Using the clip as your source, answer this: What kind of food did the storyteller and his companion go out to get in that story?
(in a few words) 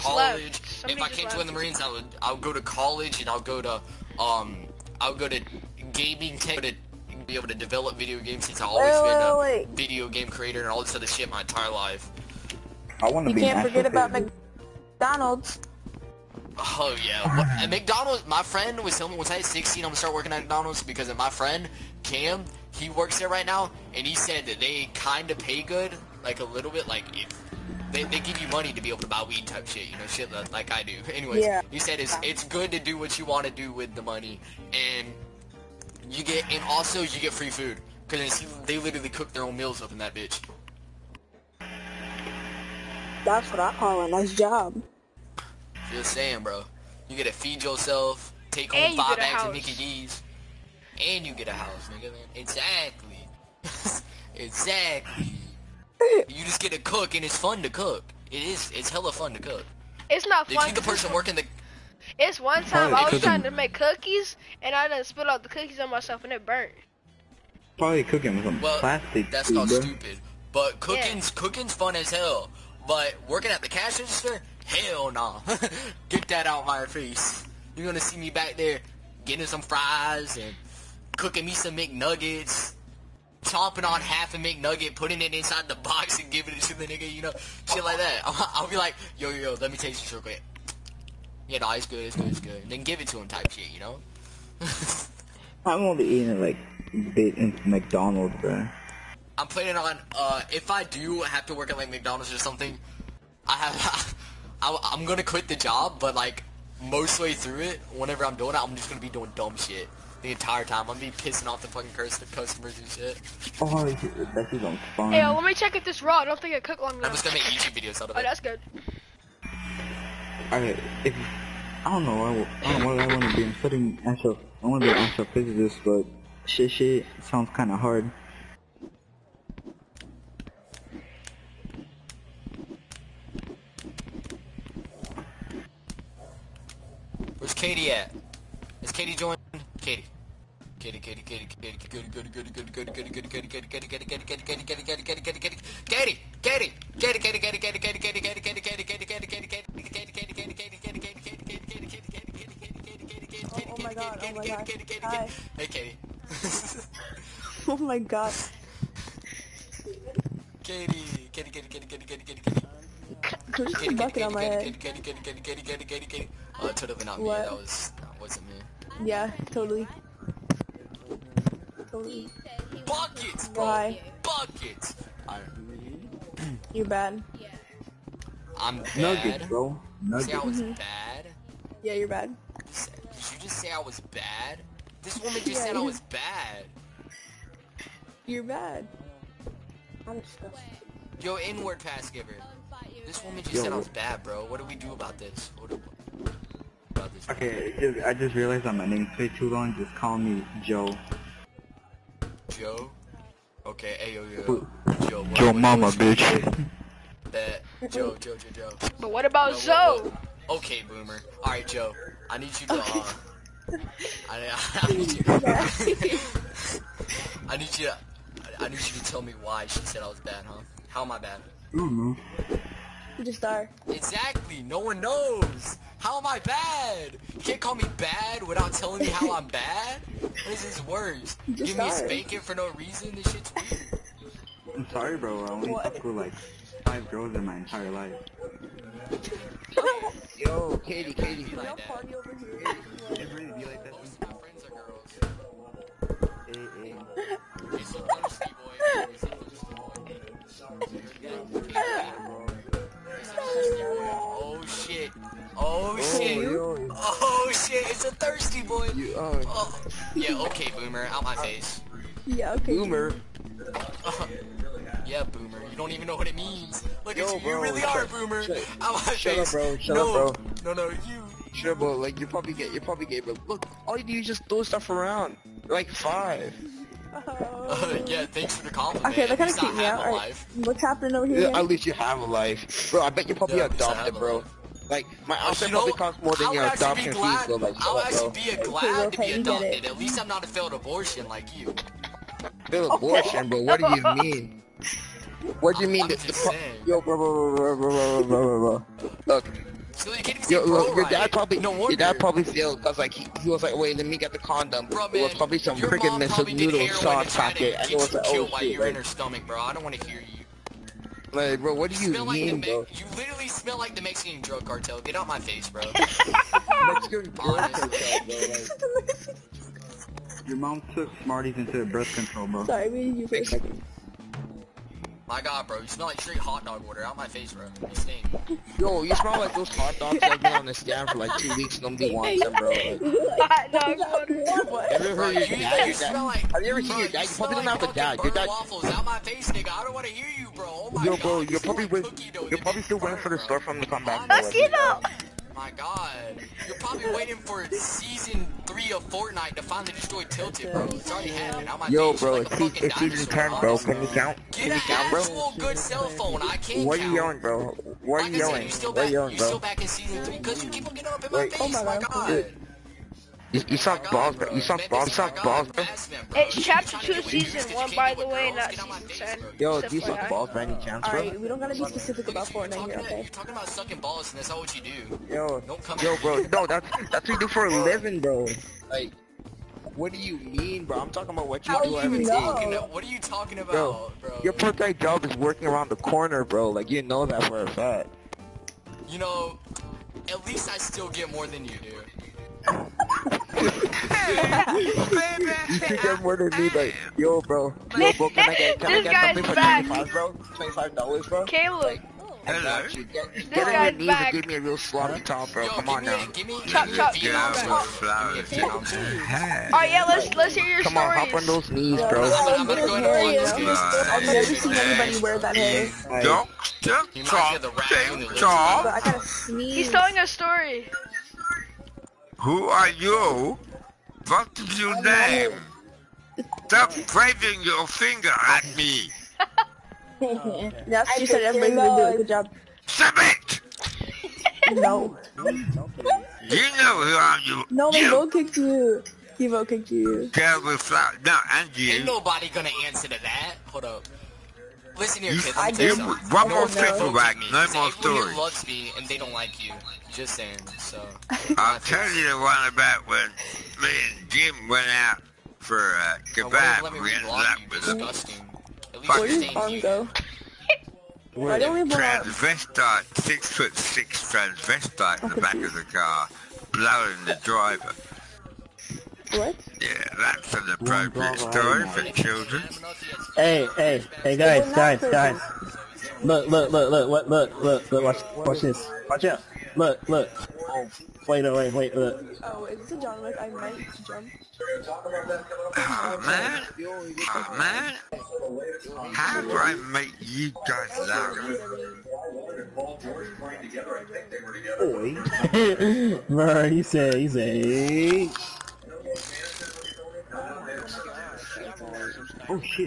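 Kebab.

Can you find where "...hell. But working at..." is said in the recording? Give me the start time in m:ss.
1:12.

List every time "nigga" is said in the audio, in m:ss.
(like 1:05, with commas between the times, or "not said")
0:51, 1:26, 5:39.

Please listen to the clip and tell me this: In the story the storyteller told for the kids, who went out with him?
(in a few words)
Jim.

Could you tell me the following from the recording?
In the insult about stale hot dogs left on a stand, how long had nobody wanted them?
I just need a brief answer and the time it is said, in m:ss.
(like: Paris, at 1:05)
2 weeks, at 5:31.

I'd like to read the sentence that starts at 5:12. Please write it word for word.
You literally smell like the Mexican drug cartel.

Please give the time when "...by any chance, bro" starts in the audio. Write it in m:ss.
6:10.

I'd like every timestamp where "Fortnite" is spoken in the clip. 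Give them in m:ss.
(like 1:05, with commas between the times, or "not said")
5:49, 6:12.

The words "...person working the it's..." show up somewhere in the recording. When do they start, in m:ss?
1:00.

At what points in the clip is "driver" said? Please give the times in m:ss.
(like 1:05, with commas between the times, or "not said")
7:47.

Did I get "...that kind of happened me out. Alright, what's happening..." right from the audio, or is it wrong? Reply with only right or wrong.
wrong.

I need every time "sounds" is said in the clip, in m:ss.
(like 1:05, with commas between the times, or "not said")
2:07.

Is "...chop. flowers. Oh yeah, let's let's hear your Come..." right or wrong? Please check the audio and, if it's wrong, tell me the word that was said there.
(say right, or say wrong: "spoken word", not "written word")
right.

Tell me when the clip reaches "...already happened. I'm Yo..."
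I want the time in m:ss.
5:51.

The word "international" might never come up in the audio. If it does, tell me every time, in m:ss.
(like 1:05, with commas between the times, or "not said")
not said.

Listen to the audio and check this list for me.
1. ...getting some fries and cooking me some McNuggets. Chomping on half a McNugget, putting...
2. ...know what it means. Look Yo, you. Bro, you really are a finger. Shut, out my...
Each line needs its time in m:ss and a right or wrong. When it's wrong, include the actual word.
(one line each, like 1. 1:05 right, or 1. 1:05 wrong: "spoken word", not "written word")
1. 1:19 right
2. 4:26 wrong: "boomer", not "finger".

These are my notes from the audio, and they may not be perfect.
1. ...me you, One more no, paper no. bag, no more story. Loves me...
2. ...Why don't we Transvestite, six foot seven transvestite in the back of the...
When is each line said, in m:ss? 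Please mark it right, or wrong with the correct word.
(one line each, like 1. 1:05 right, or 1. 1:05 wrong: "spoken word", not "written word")
1. 7:25 right
2. 7:41 wrong: "six", not "seven".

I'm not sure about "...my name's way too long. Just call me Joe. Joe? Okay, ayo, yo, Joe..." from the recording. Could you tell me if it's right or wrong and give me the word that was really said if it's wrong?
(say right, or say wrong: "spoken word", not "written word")
right.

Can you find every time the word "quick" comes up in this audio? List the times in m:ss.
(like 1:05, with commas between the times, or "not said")
1:30.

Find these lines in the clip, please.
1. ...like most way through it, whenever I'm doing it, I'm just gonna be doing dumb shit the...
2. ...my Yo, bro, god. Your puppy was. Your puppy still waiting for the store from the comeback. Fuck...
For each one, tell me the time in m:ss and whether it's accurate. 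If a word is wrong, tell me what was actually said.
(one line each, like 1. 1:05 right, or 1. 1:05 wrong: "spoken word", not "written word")
1. 1:46 right
2. 5:40 right.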